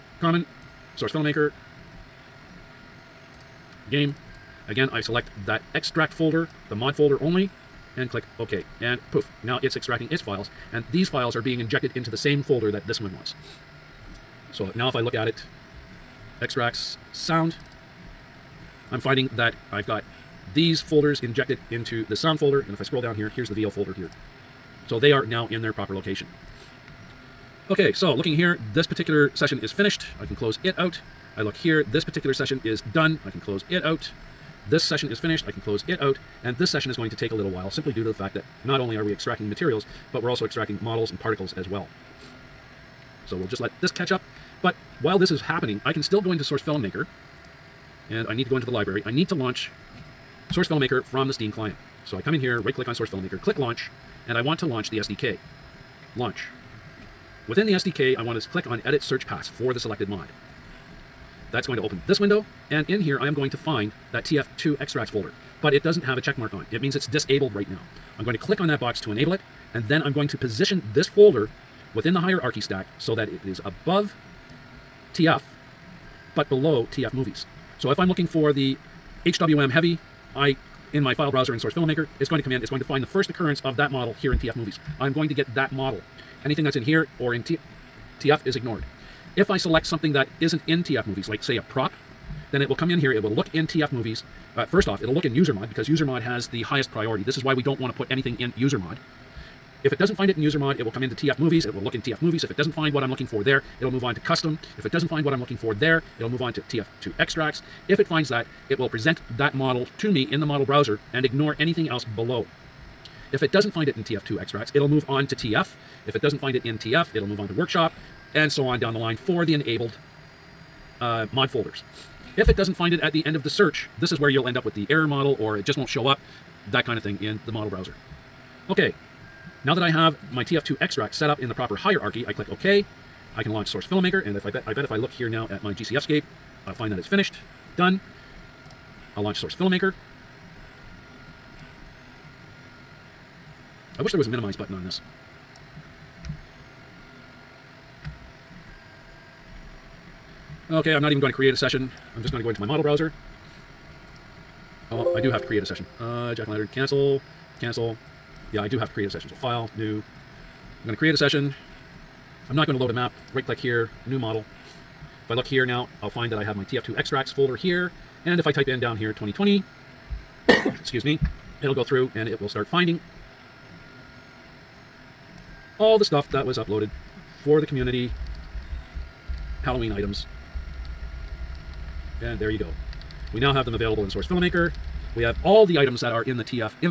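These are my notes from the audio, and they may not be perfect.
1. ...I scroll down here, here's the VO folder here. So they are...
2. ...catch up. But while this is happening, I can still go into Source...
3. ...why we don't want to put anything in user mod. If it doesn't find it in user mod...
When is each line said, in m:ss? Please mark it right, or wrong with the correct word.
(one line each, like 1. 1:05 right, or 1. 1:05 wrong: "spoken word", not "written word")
1. 0:22 right
2. 0:43 right
3. 1:37 right.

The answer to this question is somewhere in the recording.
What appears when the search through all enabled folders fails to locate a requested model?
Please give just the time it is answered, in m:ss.
2:04.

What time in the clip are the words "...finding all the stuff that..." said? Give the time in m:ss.
2:52.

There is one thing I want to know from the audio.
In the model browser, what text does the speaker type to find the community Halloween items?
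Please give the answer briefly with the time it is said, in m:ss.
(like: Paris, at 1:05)
2020, at 2:49.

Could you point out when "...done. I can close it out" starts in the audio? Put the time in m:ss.
0:32.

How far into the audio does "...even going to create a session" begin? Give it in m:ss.
2:31.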